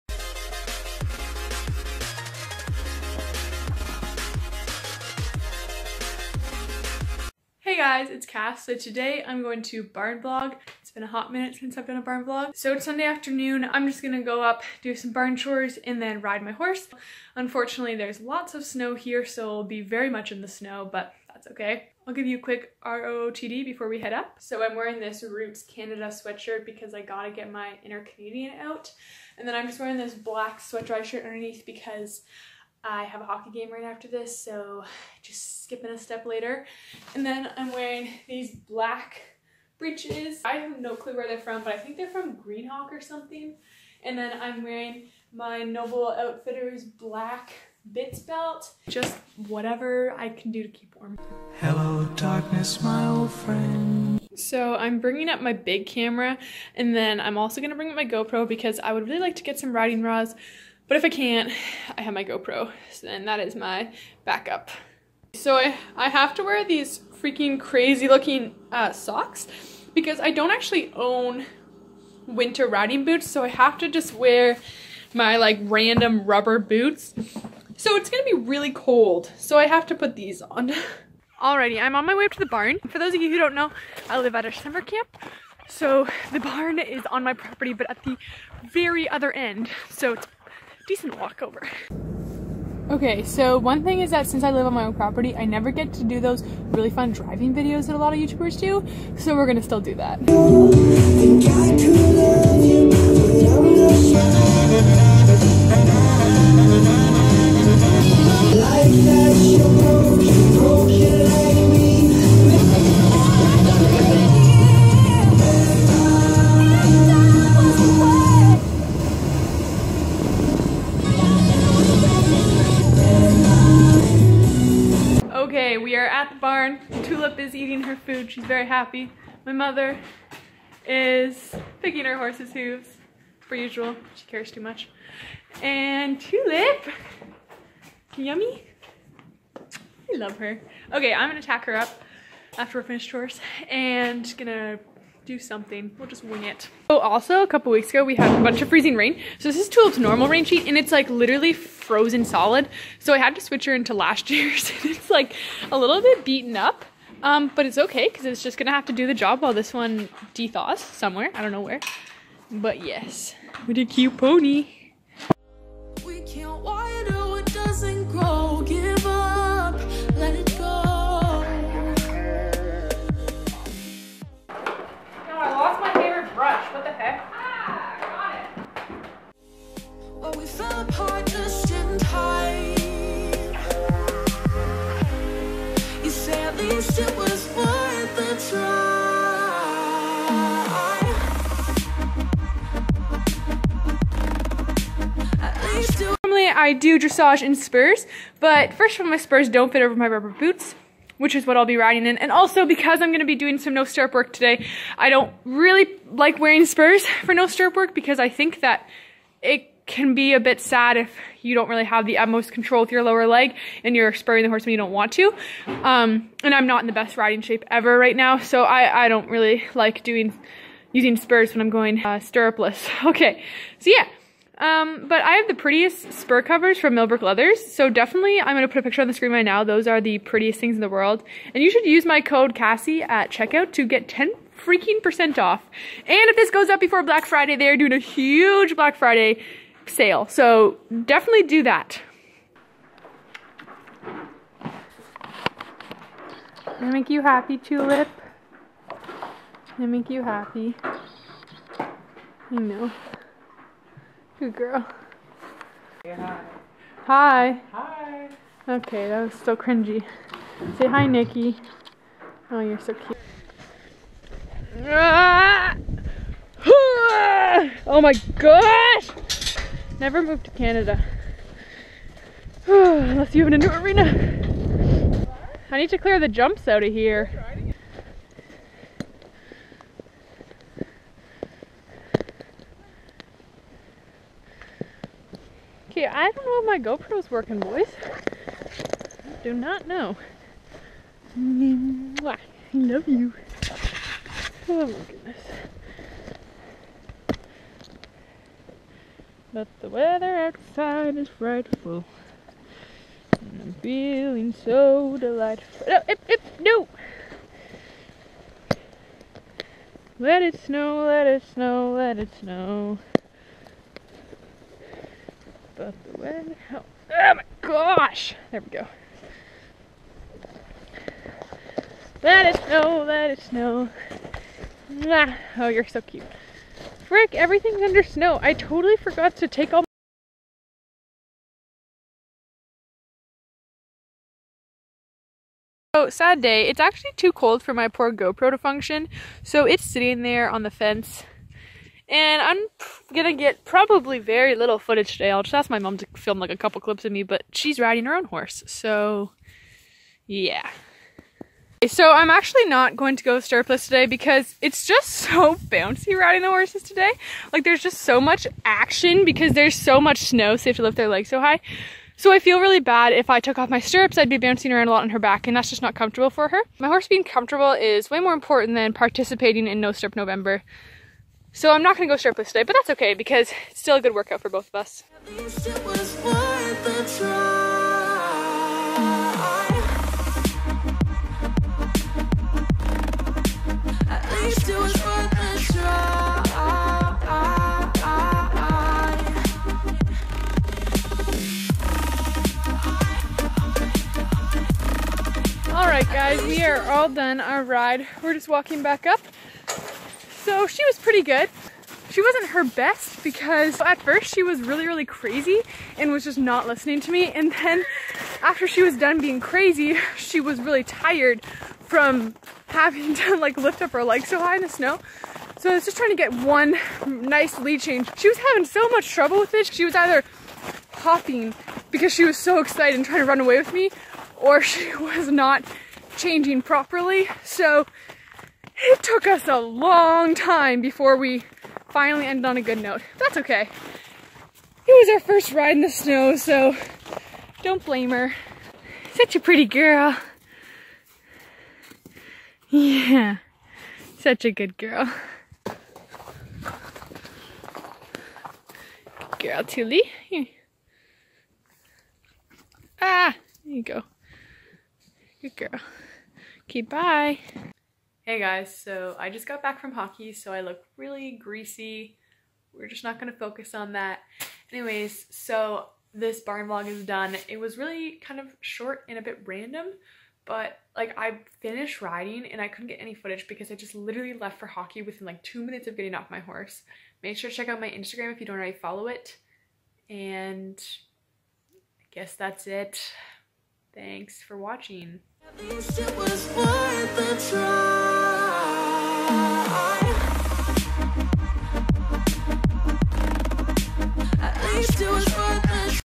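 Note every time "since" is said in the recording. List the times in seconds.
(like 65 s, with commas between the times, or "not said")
11 s, 94 s.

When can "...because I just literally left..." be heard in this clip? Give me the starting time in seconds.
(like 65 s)
473 s.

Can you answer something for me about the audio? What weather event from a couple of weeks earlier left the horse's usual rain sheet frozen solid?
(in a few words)
Freezing rain.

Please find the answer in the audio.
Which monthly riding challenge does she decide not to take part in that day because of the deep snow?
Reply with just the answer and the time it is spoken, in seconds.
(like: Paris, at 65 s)
No Stirrup November, at 369 s.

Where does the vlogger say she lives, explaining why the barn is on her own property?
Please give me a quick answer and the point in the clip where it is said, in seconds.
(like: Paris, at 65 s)
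A summer camp, at 84 s.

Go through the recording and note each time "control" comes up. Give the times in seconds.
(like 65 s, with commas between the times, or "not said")
212 s.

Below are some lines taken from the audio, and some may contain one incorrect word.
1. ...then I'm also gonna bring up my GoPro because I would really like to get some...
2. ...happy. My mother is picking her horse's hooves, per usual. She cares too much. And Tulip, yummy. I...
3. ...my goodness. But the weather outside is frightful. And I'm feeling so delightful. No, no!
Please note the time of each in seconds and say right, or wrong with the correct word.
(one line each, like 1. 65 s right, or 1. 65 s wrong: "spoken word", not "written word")
1. 56 s right
2. 128 s right
3. 294 s right.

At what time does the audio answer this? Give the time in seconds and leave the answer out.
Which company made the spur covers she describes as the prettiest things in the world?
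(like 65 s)
226 s.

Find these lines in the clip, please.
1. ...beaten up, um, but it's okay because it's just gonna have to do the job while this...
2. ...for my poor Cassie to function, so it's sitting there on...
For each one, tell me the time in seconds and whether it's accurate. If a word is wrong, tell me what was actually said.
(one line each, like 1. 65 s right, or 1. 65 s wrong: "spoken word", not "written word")
1. 156 s right
2. 337 s wrong: "GoPro", not "Cassie".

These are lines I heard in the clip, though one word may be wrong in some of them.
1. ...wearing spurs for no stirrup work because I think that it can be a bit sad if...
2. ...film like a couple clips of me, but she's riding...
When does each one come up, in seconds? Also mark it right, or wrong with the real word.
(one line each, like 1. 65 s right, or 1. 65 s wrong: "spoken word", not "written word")
1. 206 s right
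2. 346 s right.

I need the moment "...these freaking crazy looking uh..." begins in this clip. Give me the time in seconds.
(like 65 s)
66 s.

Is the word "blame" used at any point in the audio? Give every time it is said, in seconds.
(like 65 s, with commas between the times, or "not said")
437 s.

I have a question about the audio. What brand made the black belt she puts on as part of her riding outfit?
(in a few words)
Noble Outfitters.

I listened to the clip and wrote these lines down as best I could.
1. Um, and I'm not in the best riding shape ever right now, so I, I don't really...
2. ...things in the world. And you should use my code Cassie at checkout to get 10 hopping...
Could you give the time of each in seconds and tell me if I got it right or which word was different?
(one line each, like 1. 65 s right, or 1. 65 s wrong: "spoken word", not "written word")
1. 215 s right
2. 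230 s wrong: "freaking", not "hopping".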